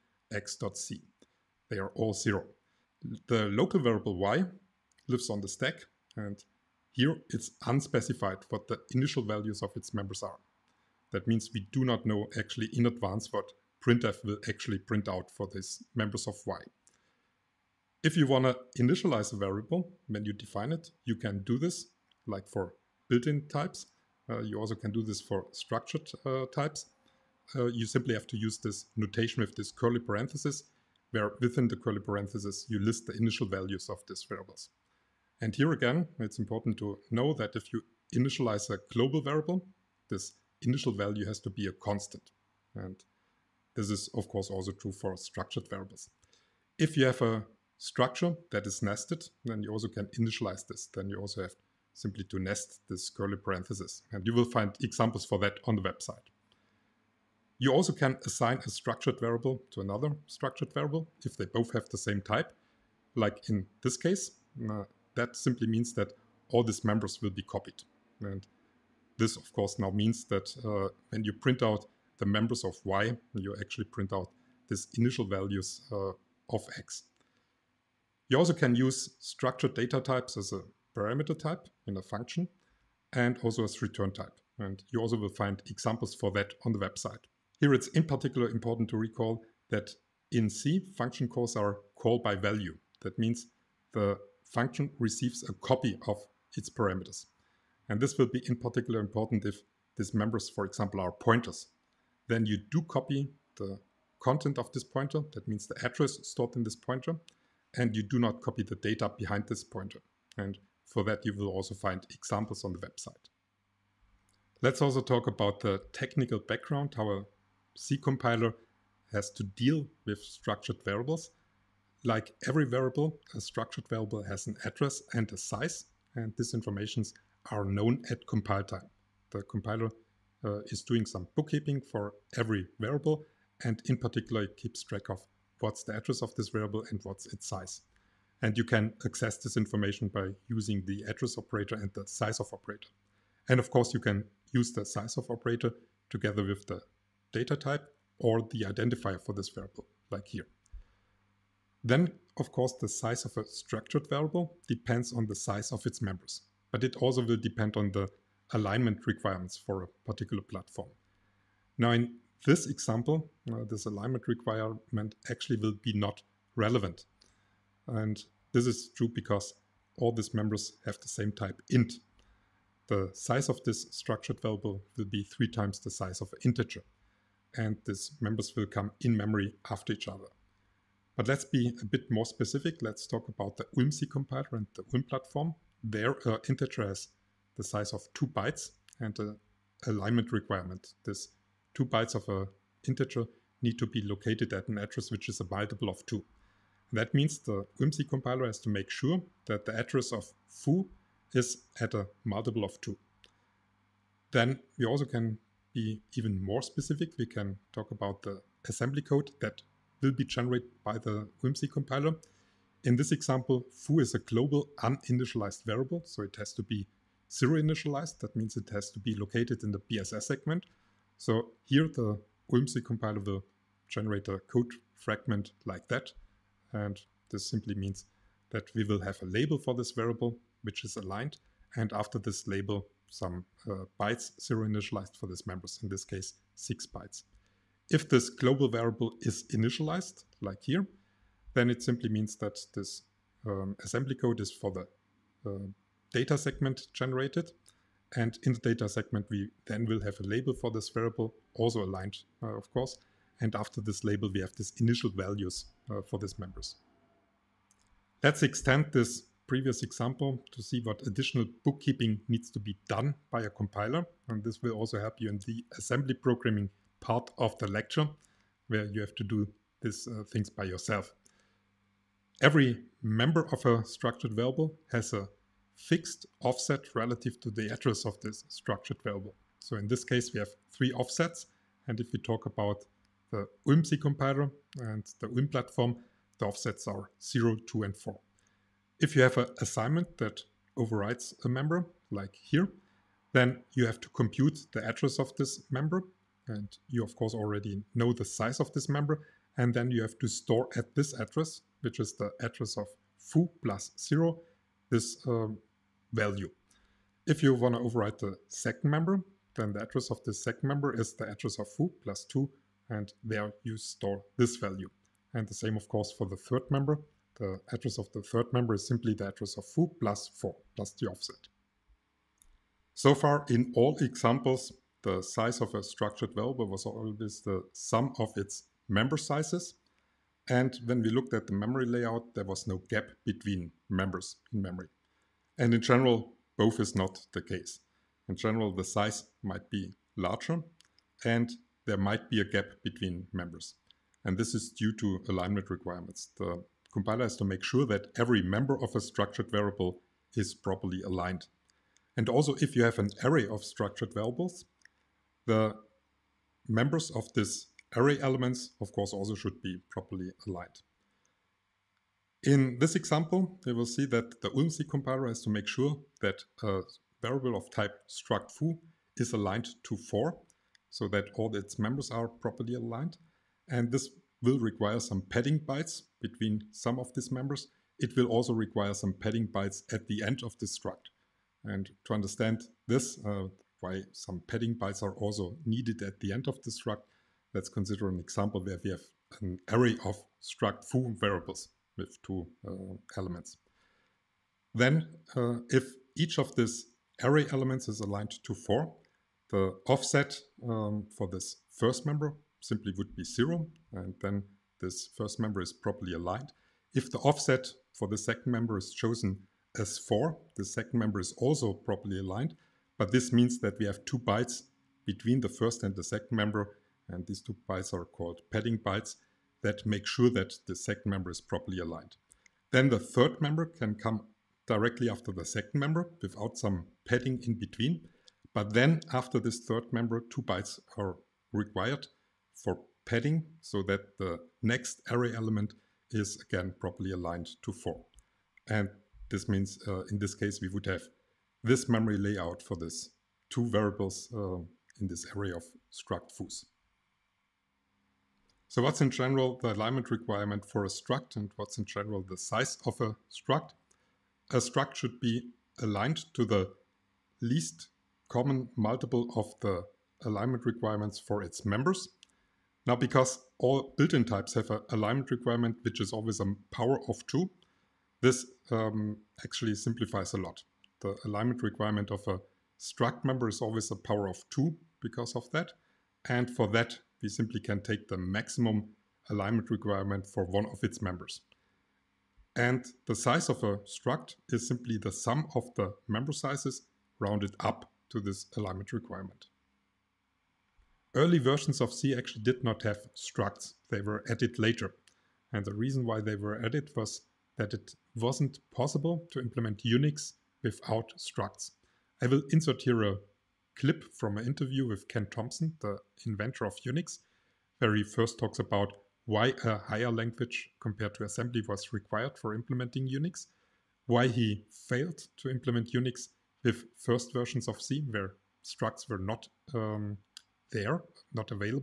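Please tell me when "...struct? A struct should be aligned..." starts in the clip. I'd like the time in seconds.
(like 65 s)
453 s.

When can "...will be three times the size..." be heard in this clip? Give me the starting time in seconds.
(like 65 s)
174 s.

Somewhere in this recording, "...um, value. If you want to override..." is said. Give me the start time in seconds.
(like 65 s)
305 s.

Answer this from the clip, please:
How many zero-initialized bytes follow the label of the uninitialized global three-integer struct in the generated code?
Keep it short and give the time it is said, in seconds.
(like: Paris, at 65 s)
6, at 236 s.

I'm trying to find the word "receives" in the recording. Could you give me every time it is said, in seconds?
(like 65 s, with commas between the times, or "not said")
94 s.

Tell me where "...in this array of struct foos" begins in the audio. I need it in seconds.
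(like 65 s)
445 s.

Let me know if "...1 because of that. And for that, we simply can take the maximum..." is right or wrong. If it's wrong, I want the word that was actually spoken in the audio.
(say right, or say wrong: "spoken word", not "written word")
wrong: "2", not "1".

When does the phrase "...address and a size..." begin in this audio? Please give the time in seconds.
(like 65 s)
124 s.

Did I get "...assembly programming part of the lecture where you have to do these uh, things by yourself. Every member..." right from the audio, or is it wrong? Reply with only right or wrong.
right.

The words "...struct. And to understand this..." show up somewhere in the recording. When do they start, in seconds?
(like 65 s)
380 s.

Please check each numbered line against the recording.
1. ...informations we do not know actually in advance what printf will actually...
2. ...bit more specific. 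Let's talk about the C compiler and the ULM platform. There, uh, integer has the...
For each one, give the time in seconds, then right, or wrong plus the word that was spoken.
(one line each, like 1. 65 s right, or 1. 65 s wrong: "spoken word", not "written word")
1. 11 s wrong: "means", not "informations"
2. 181 s right.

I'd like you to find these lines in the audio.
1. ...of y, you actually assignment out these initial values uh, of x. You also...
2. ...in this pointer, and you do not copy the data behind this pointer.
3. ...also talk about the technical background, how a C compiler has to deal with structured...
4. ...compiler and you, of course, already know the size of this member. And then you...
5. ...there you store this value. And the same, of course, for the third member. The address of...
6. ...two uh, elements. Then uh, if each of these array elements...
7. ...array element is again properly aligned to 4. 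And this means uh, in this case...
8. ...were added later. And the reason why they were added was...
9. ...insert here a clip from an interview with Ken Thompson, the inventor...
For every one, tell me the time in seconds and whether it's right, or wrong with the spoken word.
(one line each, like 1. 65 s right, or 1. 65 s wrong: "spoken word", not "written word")
1. 72 s wrong: "print", not "assignment"
2. 106 s right
3. 114 s right
4. 295 s wrong: "member", not "compiler"
5. 313 s right
6. 392 s right
7. 435 s right
8. 494 s right
9. 502 s right.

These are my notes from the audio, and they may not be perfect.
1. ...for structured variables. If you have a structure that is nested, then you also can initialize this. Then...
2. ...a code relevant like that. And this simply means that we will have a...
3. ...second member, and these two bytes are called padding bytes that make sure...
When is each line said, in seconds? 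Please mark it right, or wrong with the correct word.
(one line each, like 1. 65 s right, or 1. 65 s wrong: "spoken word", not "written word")
1. 44 s right
2. 224 s wrong: "fragment", not "relevant"
3. 416 s right.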